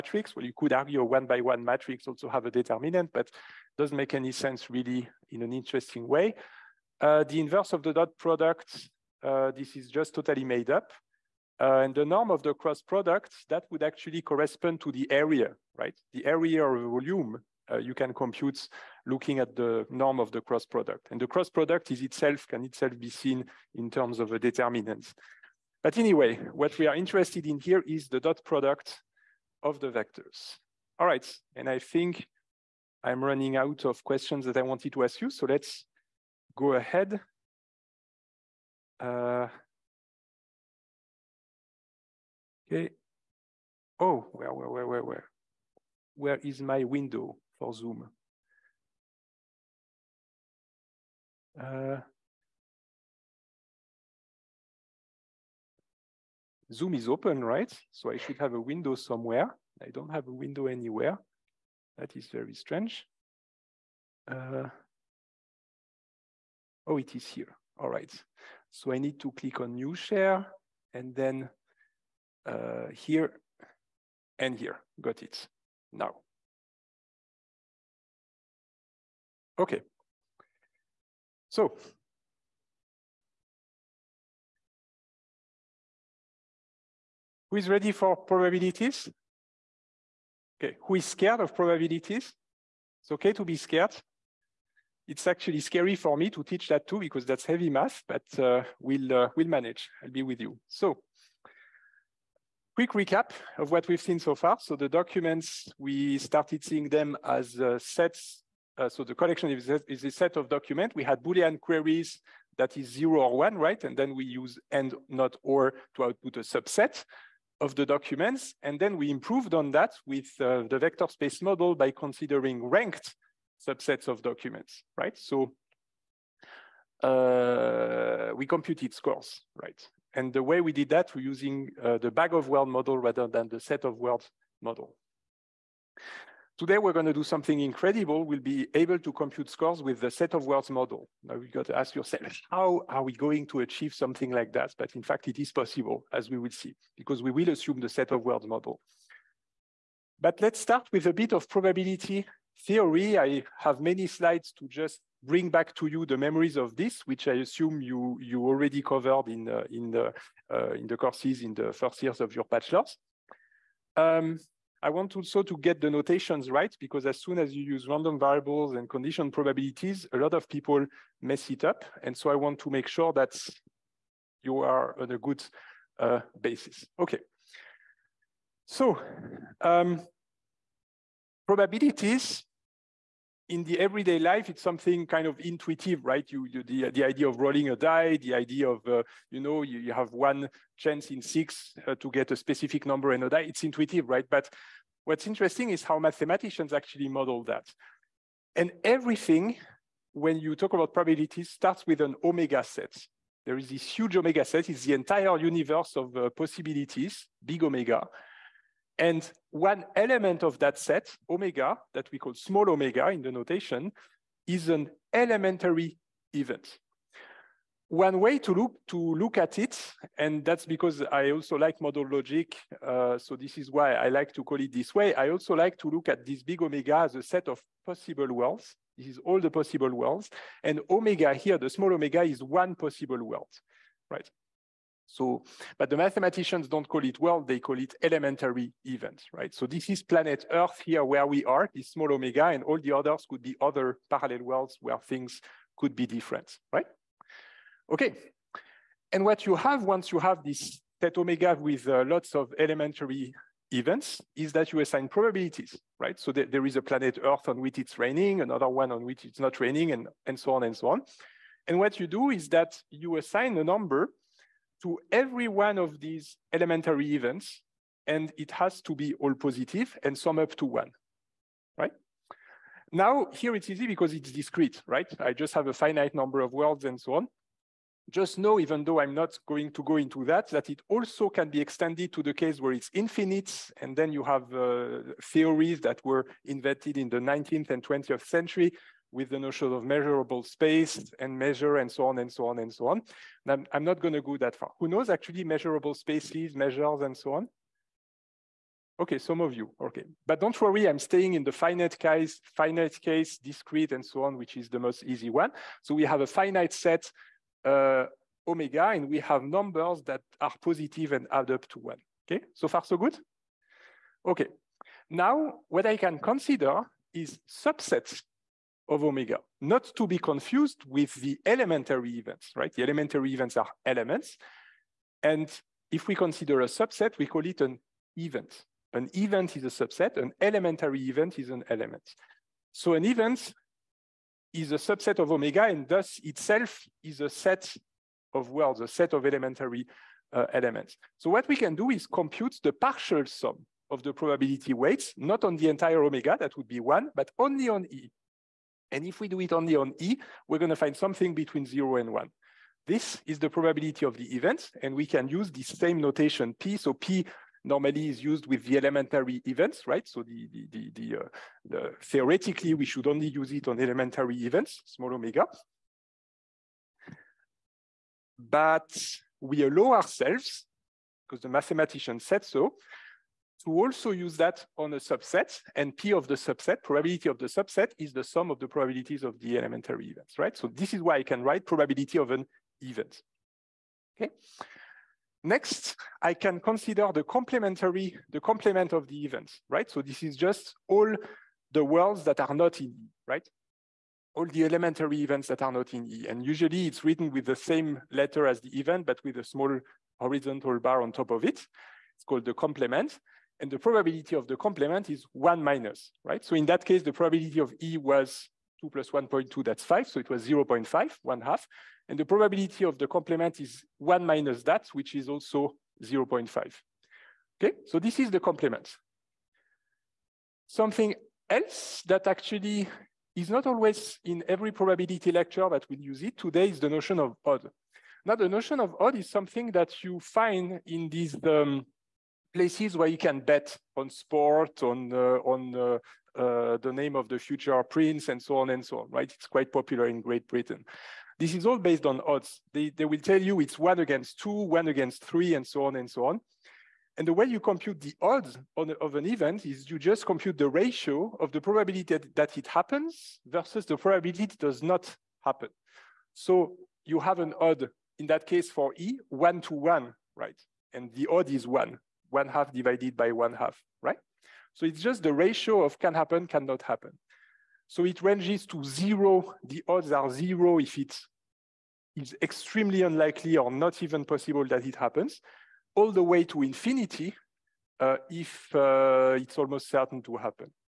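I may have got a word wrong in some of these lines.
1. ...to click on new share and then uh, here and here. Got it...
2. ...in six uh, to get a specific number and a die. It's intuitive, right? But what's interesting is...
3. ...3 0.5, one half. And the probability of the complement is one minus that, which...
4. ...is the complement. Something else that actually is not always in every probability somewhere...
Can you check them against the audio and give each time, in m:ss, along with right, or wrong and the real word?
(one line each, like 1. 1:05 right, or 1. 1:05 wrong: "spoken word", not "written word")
1. 1:09 right
2. 3:11 right
3. 6:50 wrong: "0", not "3"
4. 6:58 wrong: "lecture", not "somewhere".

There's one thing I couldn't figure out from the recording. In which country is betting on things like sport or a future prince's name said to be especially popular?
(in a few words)
Great Britain.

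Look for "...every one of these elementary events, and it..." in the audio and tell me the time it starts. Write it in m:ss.
4:25.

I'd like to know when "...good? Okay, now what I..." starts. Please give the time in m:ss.
5:12.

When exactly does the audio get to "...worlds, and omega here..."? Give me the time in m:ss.
3:49.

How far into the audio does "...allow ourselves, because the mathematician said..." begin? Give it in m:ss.
6:09.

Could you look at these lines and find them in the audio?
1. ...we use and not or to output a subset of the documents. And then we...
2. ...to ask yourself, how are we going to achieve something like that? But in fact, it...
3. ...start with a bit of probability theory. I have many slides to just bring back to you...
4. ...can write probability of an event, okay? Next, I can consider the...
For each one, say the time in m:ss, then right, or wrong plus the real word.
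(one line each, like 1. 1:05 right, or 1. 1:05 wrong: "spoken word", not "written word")
1. 1:54 right
2. 2:21 right
3. 2:30 right
4. 6:21 right.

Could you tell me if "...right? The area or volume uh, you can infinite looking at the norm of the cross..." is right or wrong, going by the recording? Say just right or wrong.
wrong.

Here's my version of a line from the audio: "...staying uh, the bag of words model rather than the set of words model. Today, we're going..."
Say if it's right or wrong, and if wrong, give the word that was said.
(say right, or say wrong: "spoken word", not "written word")
wrong: "using", not "staying".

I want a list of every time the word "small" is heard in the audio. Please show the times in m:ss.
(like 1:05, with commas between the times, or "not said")
3:32, 3:51, 4:01, 6:04, 6:39.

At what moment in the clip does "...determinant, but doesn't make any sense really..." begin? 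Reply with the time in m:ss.
0:02.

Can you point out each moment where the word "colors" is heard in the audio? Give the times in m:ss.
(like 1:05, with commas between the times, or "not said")
not said.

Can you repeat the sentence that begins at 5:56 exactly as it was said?
So P normally is used with the elementary events, right?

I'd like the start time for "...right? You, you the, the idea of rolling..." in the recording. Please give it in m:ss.
3:06.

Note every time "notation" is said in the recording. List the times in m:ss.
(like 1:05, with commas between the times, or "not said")
2:45, 3:33, 5:55.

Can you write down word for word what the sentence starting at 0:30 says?
All right, and I think I'm running out of questions that I wanted to ask you, so let's go ahead.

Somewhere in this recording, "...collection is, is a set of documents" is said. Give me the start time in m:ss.
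1:49.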